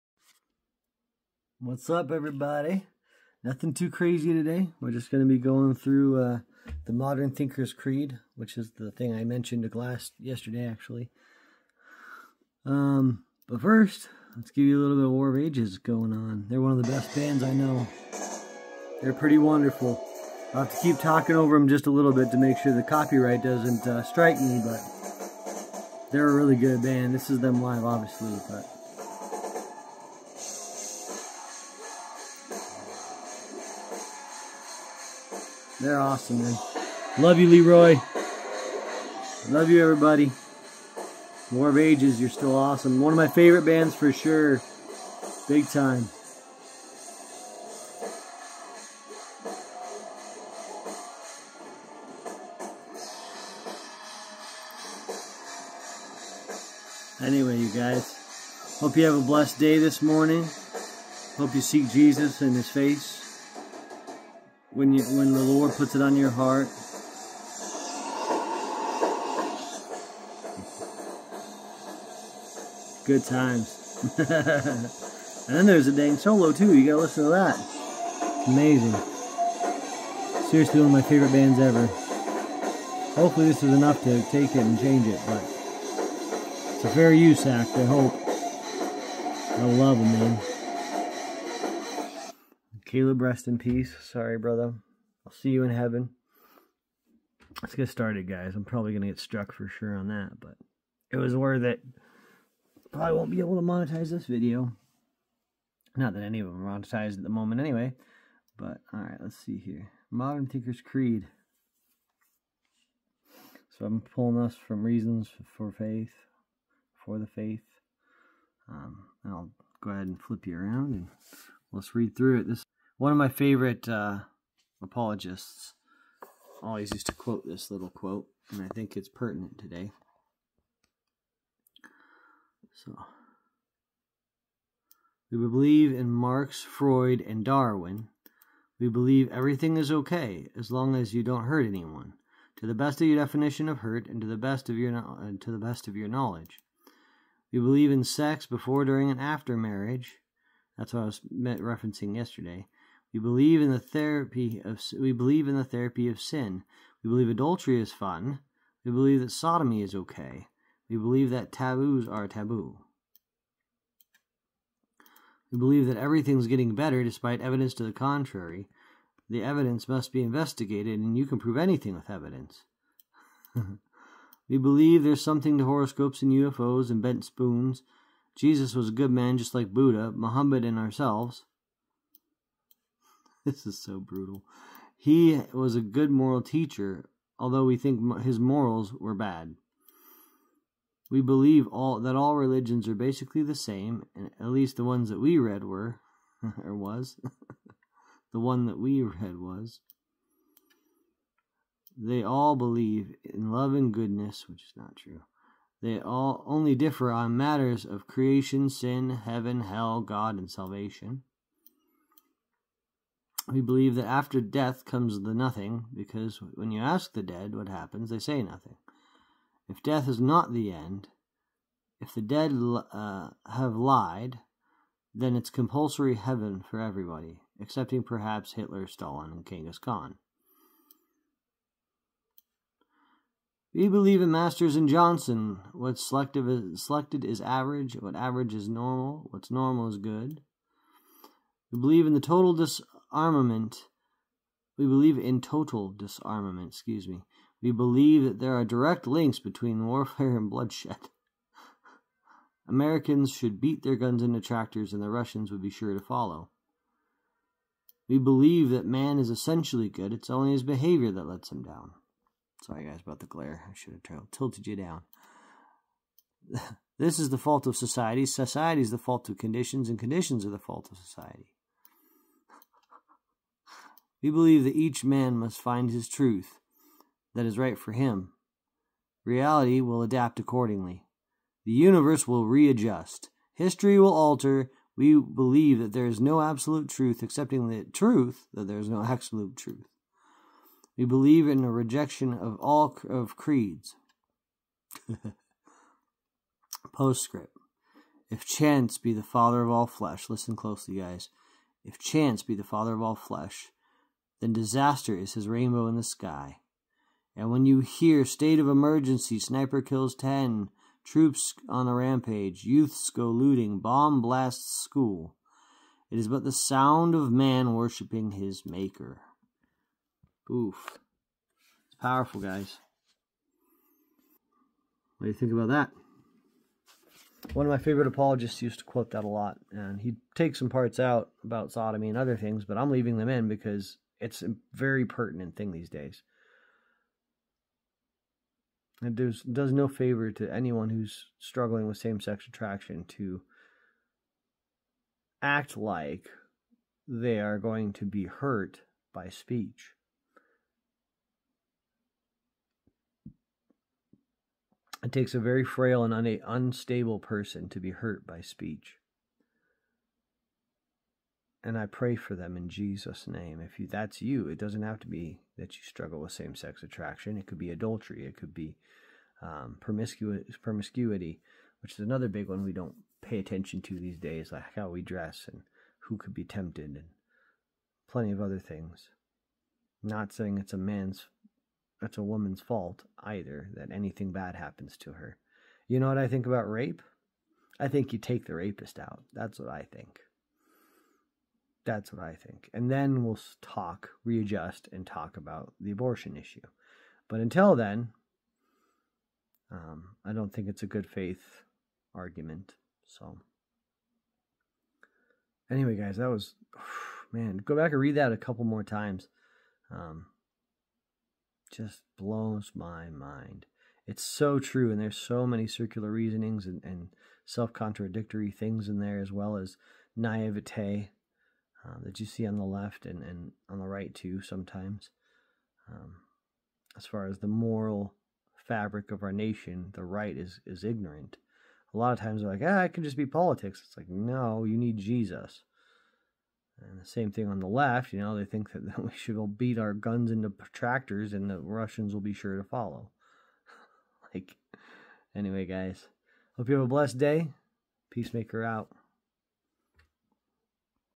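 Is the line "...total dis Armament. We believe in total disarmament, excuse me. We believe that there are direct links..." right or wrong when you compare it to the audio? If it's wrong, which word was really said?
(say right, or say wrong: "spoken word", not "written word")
right.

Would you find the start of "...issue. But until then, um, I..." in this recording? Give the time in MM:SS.
06:36.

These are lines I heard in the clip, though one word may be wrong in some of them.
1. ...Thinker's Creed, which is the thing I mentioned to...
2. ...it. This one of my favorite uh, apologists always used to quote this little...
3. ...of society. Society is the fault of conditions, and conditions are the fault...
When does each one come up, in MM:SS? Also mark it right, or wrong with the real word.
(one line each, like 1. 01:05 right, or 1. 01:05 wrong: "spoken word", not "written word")
1. 00:07 right
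2. 02:02 right
3. 04:27 right.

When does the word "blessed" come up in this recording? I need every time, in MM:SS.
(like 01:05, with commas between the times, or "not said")
00:59, 07:26.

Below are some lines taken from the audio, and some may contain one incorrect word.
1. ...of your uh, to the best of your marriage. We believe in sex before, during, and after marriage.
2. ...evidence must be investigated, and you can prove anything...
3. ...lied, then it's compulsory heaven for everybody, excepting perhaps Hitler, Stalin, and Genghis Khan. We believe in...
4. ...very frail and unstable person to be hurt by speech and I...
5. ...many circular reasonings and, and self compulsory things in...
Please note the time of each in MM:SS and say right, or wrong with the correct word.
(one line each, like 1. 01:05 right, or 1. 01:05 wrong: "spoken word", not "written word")
1. 02:24 wrong: "knowledge", not "marriage"
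2. 02:49 right
3. 03:43 right
4. 05:55 right
5. 06:55 wrong: "contradictory", not "compulsory".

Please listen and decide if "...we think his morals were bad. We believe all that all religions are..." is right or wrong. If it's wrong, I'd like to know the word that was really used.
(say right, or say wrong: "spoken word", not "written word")
right.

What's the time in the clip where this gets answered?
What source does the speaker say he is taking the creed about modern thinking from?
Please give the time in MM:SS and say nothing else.
01:54.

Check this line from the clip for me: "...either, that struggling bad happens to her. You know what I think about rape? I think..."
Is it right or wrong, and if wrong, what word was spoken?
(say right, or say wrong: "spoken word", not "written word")
wrong: "anything", not "struggling".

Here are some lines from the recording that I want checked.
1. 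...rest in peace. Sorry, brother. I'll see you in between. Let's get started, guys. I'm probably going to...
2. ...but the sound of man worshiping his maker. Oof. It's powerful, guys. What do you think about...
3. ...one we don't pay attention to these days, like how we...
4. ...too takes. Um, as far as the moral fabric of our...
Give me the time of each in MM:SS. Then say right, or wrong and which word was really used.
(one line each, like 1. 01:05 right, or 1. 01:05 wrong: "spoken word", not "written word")
1. 01:33 wrong: "heaven", not "between"
2. 05:16 right
3. 06:12 right
4. 07:04 wrong: "sometimes", not "takes".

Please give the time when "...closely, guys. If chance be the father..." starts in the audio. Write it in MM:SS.
05:00.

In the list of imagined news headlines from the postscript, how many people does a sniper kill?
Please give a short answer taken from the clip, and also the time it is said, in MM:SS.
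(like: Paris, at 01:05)
10, at 05:10.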